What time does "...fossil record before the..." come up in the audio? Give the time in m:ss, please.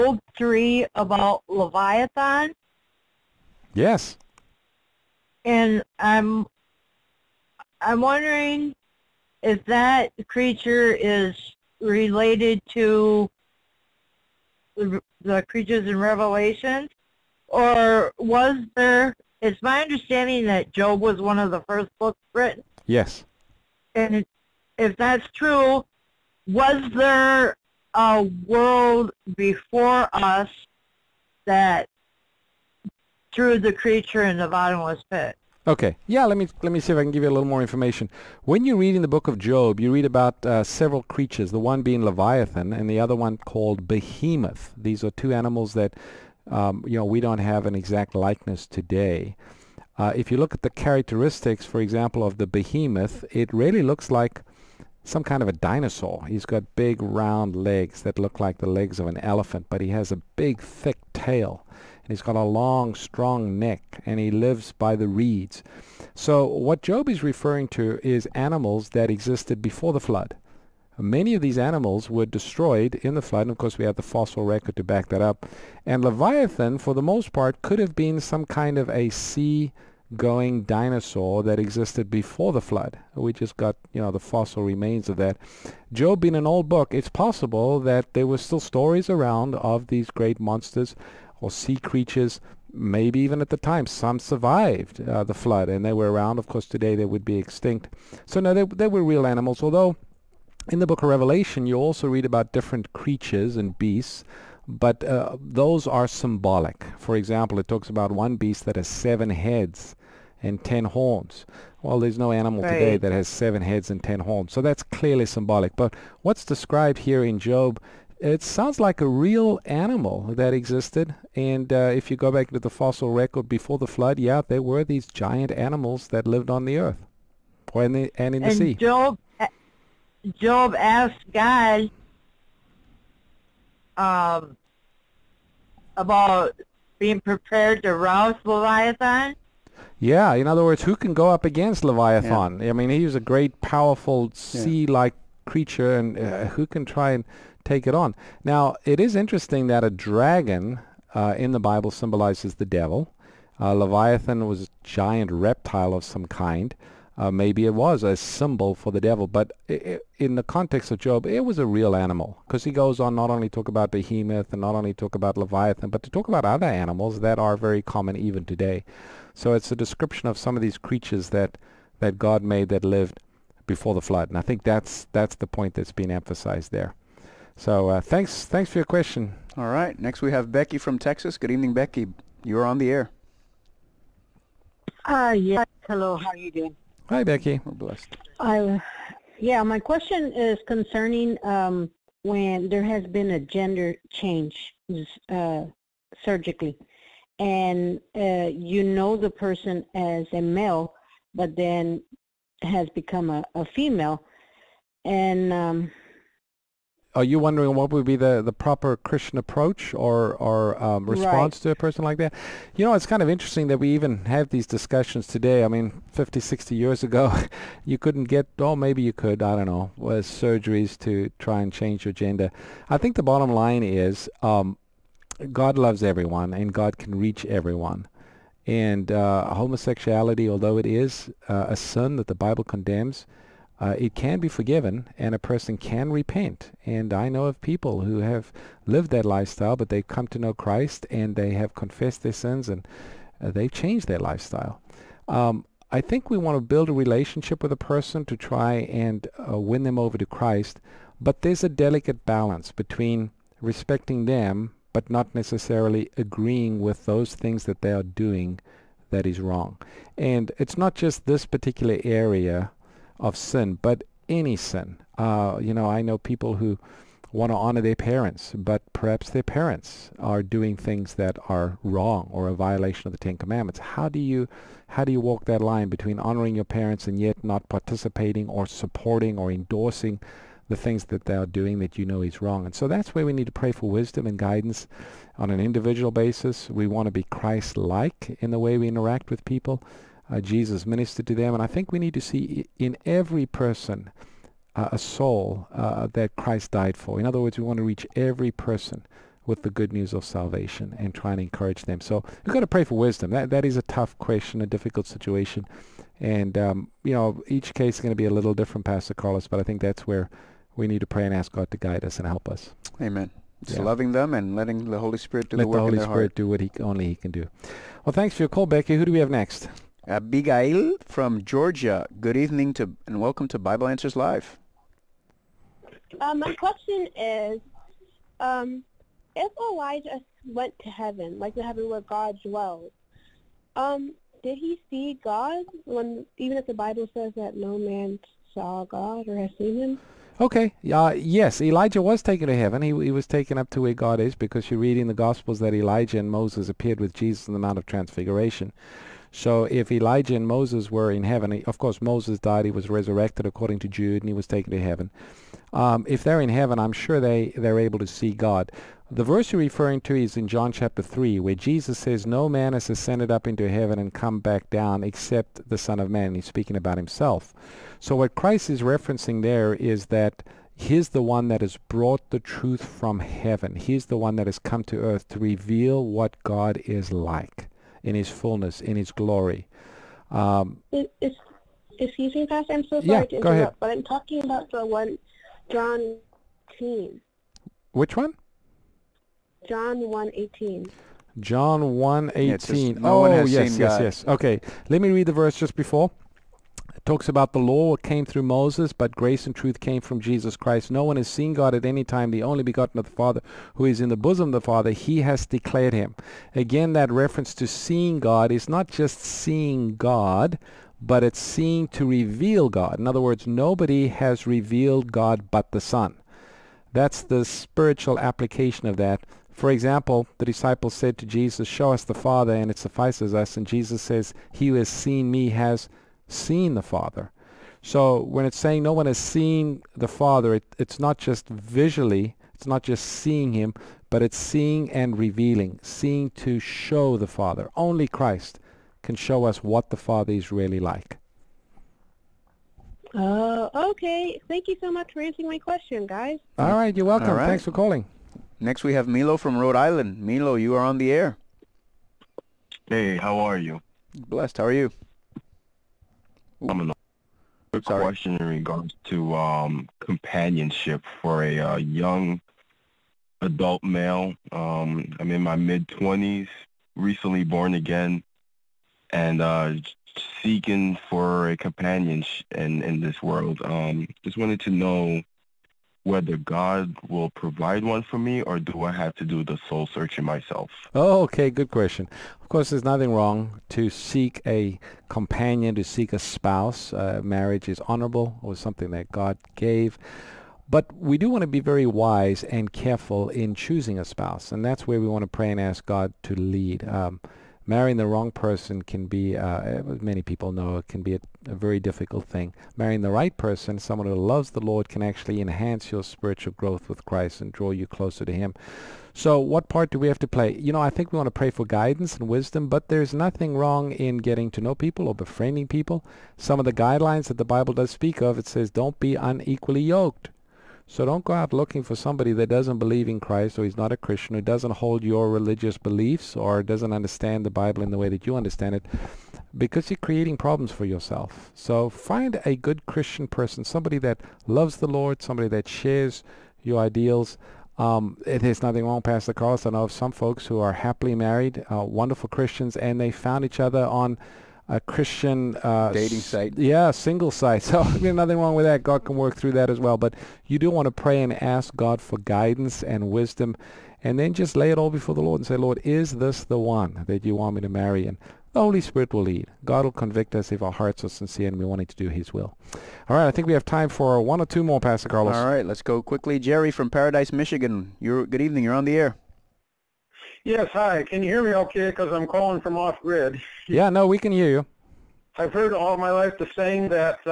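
2:02.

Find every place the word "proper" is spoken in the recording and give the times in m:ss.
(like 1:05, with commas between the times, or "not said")
3:28.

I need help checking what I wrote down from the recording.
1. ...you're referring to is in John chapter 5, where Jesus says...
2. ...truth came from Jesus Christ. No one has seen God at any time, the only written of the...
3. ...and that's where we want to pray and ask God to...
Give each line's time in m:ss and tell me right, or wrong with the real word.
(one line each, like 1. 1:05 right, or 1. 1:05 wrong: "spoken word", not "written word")
1. 5:59 wrong: "3", not "5"
2. 6:39 wrong: "begotten", not "written"
3. 8:14 right.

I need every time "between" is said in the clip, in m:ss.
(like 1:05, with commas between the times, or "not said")
4:12, 4:35.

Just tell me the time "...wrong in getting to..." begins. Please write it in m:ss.
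8:33.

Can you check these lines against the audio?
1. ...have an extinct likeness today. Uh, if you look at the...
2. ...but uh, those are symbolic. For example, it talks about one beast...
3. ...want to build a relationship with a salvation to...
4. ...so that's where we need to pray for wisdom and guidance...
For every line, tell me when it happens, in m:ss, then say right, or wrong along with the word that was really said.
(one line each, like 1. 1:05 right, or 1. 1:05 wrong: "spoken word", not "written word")
1. 0:47 wrong: "exact", not "extinct"
2. 1:44 right
3. 4:06 wrong: "person", not "salvation"
4. 4:42 right.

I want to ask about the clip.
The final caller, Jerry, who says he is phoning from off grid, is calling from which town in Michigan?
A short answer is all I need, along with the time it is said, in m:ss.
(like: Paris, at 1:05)
Paradise, at 9:26.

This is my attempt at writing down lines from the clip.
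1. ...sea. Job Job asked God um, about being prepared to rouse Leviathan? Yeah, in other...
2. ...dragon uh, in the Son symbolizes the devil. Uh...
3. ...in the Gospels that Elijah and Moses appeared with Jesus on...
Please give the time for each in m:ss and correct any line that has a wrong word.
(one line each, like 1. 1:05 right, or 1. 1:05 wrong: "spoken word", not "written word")
1. 2:08 right
2. 2:29 wrong: "Bible", not "Son"
3. 5:44 right.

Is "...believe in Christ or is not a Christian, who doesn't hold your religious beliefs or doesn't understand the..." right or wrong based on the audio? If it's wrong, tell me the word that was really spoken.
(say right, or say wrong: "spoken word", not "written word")
right.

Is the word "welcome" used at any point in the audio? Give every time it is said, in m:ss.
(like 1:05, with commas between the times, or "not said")
5:23, 7:27.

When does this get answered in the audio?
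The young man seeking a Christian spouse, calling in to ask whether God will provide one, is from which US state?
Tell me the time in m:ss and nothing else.
7:29.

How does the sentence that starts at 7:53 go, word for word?
Um, just wanted to know whether God will provide one for me or do I have to do the soul searching myself?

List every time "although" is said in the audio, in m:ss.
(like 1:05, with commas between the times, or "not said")
1:39, 3:50.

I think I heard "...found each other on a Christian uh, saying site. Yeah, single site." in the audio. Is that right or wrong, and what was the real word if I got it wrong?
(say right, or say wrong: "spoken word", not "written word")
wrong: "dating", not "saying".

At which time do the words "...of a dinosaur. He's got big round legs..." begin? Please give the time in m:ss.
0:55.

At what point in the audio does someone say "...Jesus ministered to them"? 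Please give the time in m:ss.
4:50.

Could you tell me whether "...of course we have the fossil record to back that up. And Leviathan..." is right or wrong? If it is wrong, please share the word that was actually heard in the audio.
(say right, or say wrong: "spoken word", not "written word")
right.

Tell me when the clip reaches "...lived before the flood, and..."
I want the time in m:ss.
2:52.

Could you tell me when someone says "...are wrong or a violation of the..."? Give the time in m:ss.
4:31.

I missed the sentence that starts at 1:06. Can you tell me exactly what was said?
So what Job is referring to is animals that existed before the flood.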